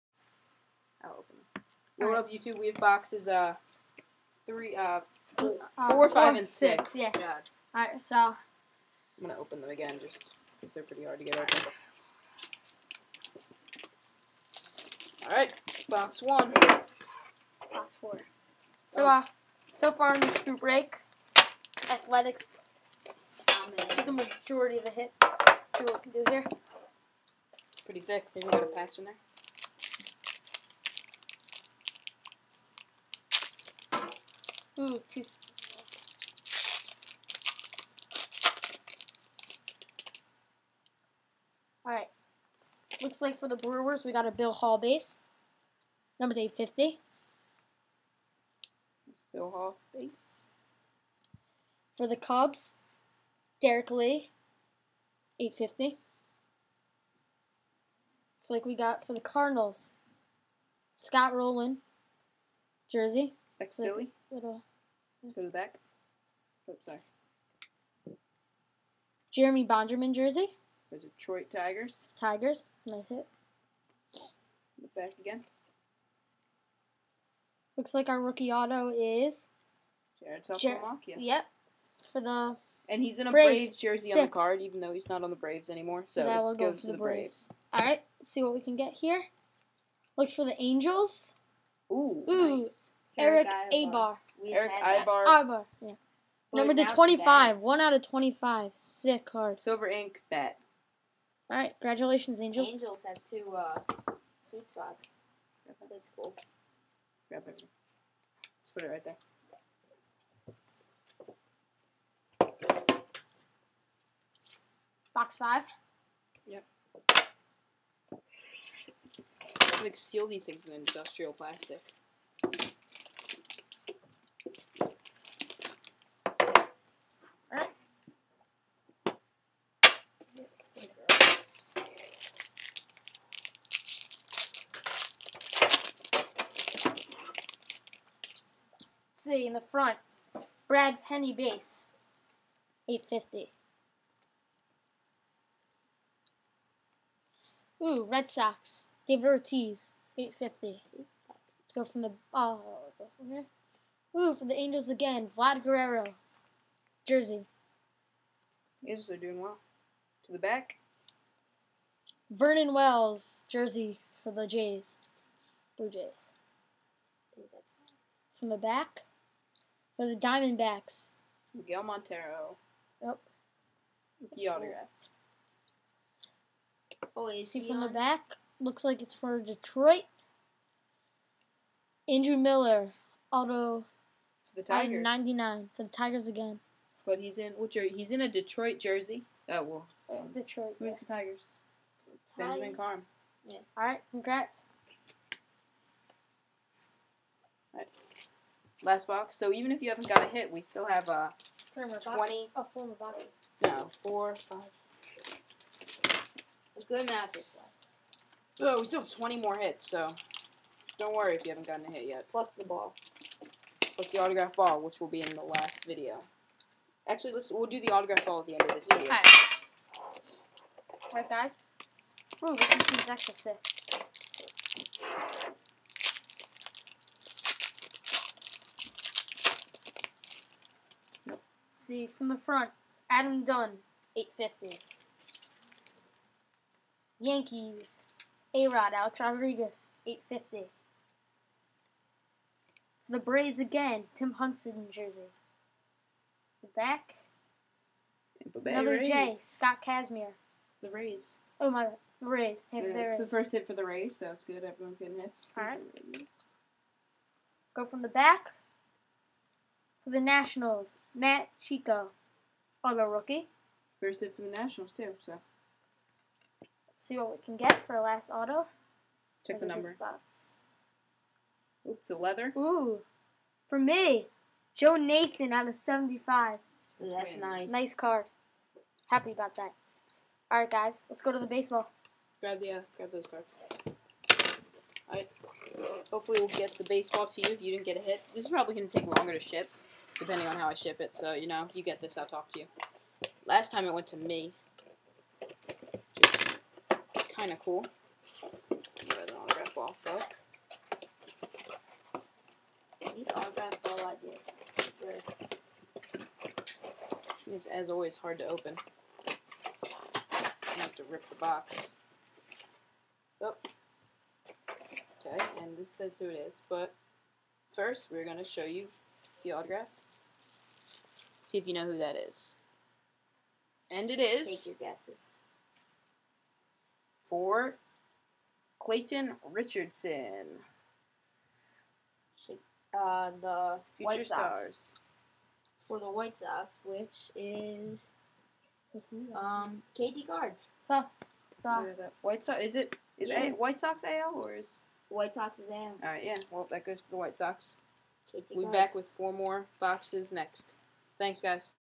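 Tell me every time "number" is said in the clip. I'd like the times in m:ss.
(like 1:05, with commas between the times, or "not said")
0:46, 1:36, 4:29.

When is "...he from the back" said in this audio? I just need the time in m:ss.
2:57.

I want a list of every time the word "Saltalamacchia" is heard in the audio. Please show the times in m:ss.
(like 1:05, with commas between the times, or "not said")
1:20.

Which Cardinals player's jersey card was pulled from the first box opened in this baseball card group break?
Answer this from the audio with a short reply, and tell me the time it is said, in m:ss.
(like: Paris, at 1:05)
Scott Rolen, at 1:00.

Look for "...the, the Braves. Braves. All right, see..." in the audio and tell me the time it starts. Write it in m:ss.
1:26.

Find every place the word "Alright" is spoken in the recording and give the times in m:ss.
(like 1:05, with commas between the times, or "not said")
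0:41, 3:39.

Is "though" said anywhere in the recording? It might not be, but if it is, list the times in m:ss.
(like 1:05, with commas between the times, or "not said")
1:24, 5:00.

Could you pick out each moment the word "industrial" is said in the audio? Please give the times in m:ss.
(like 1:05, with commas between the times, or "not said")
2:00.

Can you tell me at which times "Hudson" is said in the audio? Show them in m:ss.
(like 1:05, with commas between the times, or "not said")
4:04.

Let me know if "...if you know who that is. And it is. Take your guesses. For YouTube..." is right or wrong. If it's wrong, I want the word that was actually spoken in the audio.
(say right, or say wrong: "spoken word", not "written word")
wrong: "Clayton", not "YouTube".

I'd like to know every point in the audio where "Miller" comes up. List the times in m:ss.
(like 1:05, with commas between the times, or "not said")
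3:02.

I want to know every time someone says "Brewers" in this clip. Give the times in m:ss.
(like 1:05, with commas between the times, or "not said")
0:43.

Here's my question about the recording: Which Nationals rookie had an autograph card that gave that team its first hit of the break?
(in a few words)
Matt Chico.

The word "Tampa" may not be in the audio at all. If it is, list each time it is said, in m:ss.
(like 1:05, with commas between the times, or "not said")
4:08, 4:12.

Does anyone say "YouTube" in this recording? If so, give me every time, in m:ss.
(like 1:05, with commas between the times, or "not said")
0:02.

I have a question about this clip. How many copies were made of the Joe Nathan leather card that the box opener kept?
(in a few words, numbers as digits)
75.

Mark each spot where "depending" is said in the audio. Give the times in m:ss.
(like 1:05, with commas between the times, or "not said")
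4:50.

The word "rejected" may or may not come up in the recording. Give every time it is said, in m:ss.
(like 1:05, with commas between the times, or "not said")
not said.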